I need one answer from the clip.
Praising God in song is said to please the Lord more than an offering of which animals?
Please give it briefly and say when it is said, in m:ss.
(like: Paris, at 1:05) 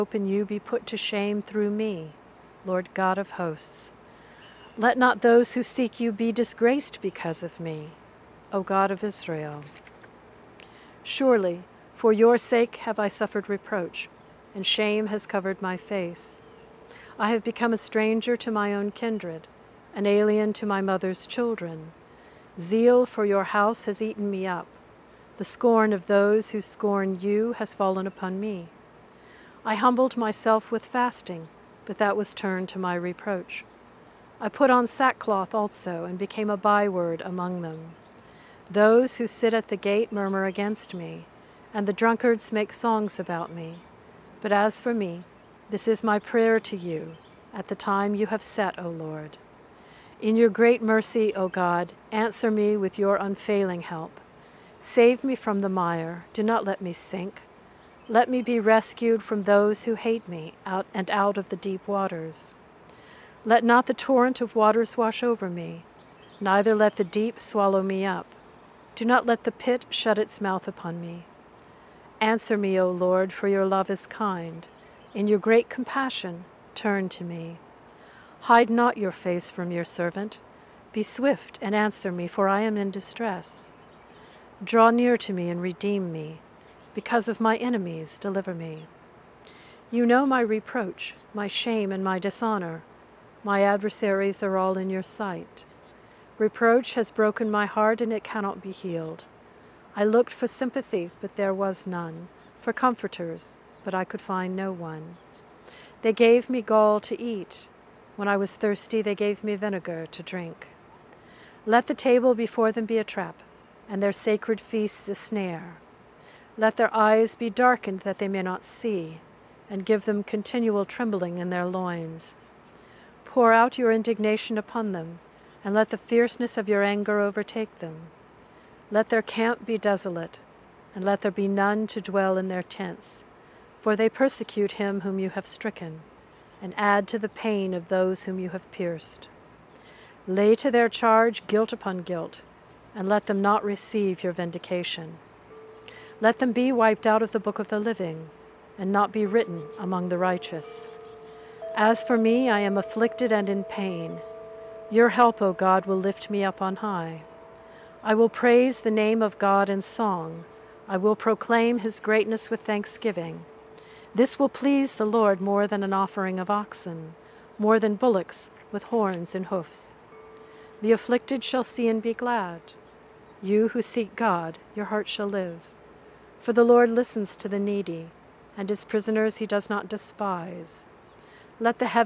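Oxen, at 2:46.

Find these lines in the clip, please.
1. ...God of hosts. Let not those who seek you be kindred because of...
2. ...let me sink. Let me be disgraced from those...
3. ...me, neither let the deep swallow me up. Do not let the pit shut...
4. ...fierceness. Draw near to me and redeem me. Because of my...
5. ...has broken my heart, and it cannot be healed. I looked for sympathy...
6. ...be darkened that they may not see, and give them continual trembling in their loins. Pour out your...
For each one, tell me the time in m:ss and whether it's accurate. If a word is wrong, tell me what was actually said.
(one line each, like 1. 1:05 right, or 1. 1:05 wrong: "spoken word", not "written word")
1. 0:02 wrong: "disgraced", not "kindred"
2. 0:56 wrong: "rescued", not "disgraced"
3. 1:05 right
4. 1:22 wrong: "distress", not "fierceness"
5. 1:36 right
6. 1:57 right.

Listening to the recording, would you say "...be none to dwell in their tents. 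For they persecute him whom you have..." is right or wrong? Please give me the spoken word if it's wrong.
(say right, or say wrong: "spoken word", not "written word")
right.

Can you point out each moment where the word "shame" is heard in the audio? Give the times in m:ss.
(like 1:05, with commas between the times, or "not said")
0:00, 0:14, 1:31.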